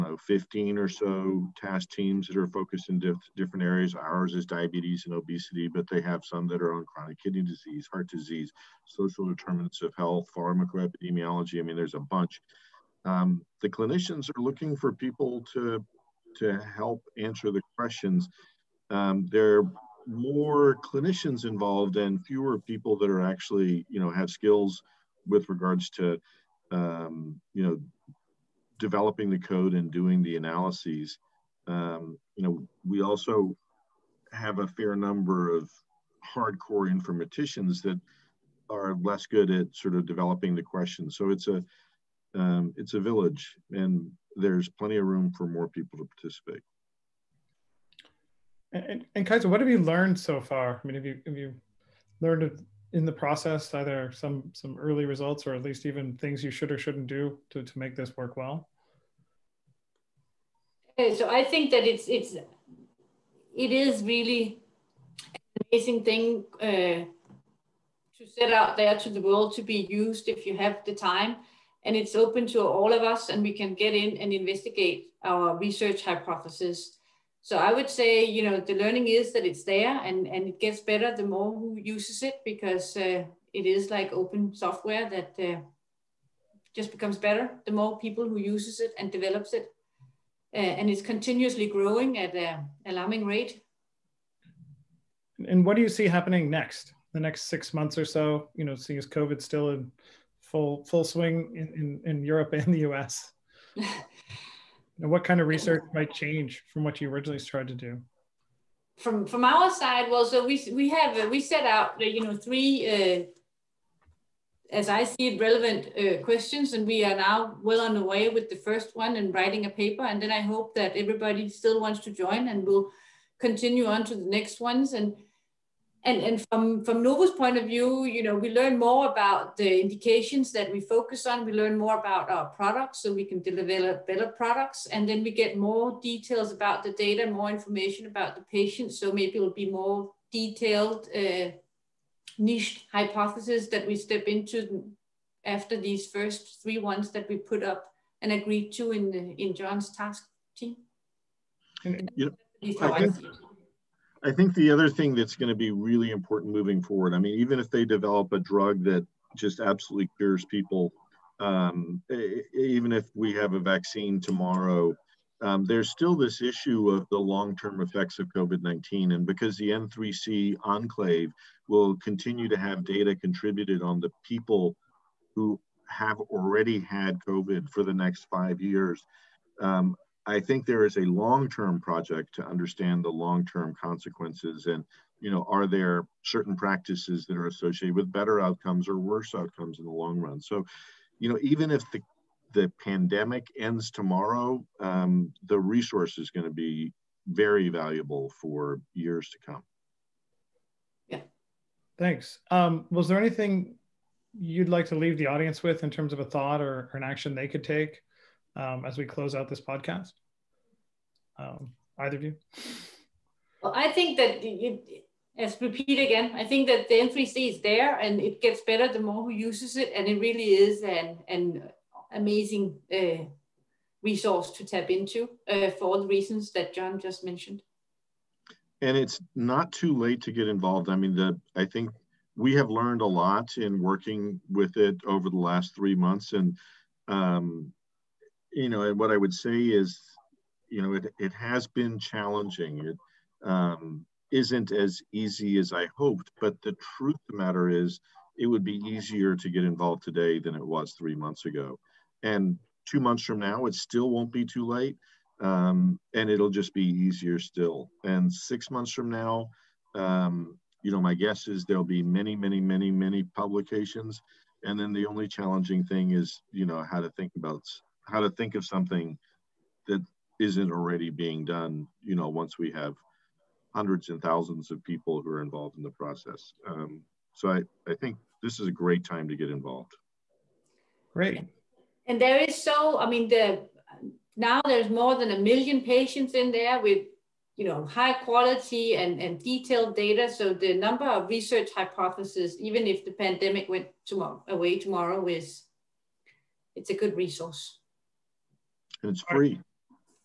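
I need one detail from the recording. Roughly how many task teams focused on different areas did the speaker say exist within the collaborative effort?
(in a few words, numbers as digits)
15.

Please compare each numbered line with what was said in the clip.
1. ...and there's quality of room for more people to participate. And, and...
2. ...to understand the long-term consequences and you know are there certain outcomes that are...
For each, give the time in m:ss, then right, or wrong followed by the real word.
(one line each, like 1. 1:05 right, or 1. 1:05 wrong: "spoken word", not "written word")
1. 0:43 wrong: "plenty", not "quality"
2. 3:02 wrong: "practices", not "outcomes".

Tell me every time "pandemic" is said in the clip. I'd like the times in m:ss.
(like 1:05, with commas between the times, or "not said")
3:12, 4:53.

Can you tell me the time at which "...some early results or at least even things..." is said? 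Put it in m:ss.
0:54.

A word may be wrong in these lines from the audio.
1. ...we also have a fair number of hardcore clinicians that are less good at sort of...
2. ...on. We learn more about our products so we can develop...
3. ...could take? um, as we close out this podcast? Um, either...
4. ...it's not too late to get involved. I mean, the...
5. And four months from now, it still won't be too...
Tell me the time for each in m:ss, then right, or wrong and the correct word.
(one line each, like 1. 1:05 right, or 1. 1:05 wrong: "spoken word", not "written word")
1. 0:32 wrong: "informaticians", not "clinicians"
2. 2:11 right
3. 3:27 right
4. 3:48 right
5. 4:12 wrong: "two", not "four".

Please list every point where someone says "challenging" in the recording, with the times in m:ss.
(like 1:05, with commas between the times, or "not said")
4:01, 4:25.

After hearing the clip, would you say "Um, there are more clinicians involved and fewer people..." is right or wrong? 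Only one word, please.
right.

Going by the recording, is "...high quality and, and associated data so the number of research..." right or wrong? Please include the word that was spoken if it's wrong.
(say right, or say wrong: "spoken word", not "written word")
wrong: "detailed", not "associated".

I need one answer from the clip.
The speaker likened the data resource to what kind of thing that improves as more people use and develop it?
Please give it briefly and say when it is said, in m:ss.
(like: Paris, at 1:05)
open software, at 1:24.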